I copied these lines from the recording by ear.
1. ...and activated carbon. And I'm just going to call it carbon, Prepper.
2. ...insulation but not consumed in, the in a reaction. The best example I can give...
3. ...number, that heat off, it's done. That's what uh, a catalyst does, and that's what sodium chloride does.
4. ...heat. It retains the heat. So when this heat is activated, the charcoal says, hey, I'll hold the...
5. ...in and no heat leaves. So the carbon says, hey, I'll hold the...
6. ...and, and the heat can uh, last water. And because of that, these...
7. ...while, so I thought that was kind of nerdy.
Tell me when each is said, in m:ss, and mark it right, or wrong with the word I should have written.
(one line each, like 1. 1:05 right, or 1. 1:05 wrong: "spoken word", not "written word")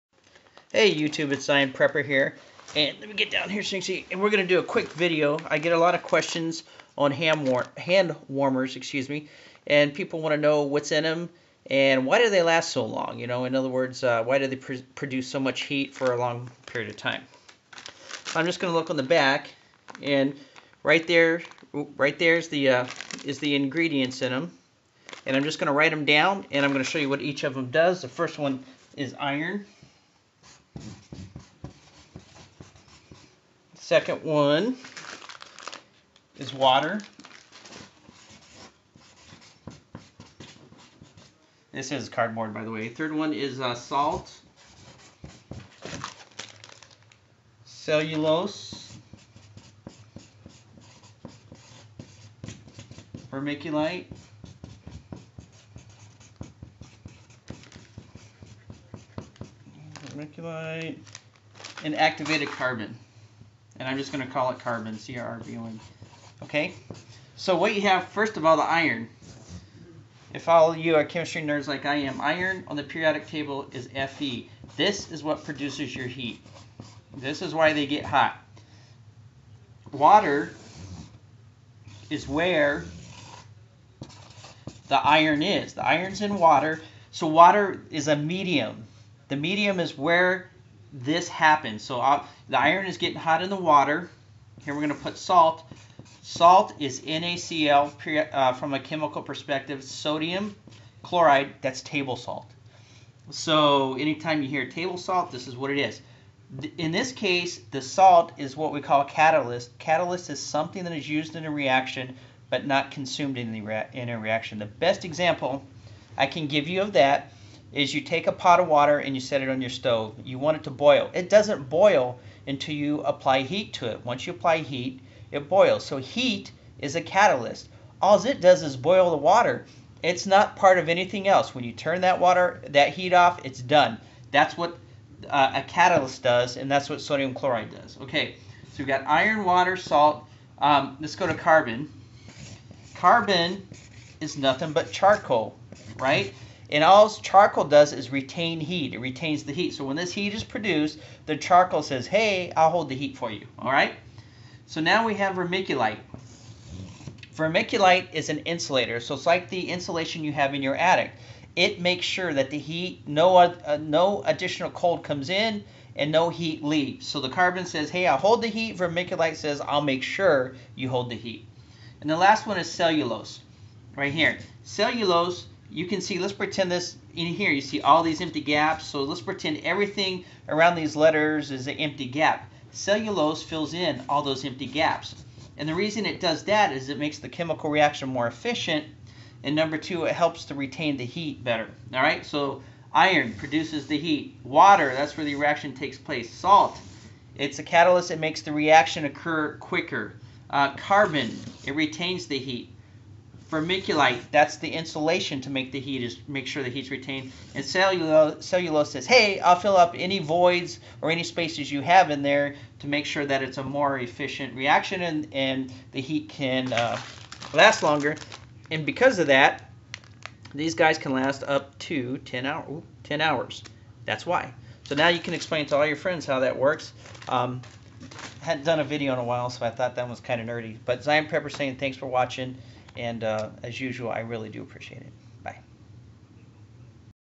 1. 1:01 wrong: "CRBON", not "Prepper"
2. 1:51 wrong: "reaction", not "insulation"
3. 2:12 wrong: "water", not "number"
4. 2:28 wrong: "produced", not "activated"
5. 2:45 right
6. 3:35 wrong: "longer", not "water"
7. 3:49 right.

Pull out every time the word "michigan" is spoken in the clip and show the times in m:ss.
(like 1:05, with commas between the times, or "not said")
not said.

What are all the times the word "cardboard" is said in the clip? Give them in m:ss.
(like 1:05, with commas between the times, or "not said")
0:42.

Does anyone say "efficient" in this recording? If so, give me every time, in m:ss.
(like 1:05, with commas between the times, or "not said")
3:08, 3:33.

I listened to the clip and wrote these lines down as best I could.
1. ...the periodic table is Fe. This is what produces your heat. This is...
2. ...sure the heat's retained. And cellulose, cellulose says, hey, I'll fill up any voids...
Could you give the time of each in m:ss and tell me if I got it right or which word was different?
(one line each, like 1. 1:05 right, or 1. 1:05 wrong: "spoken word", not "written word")
1. 1:12 right
2. 3:26 right.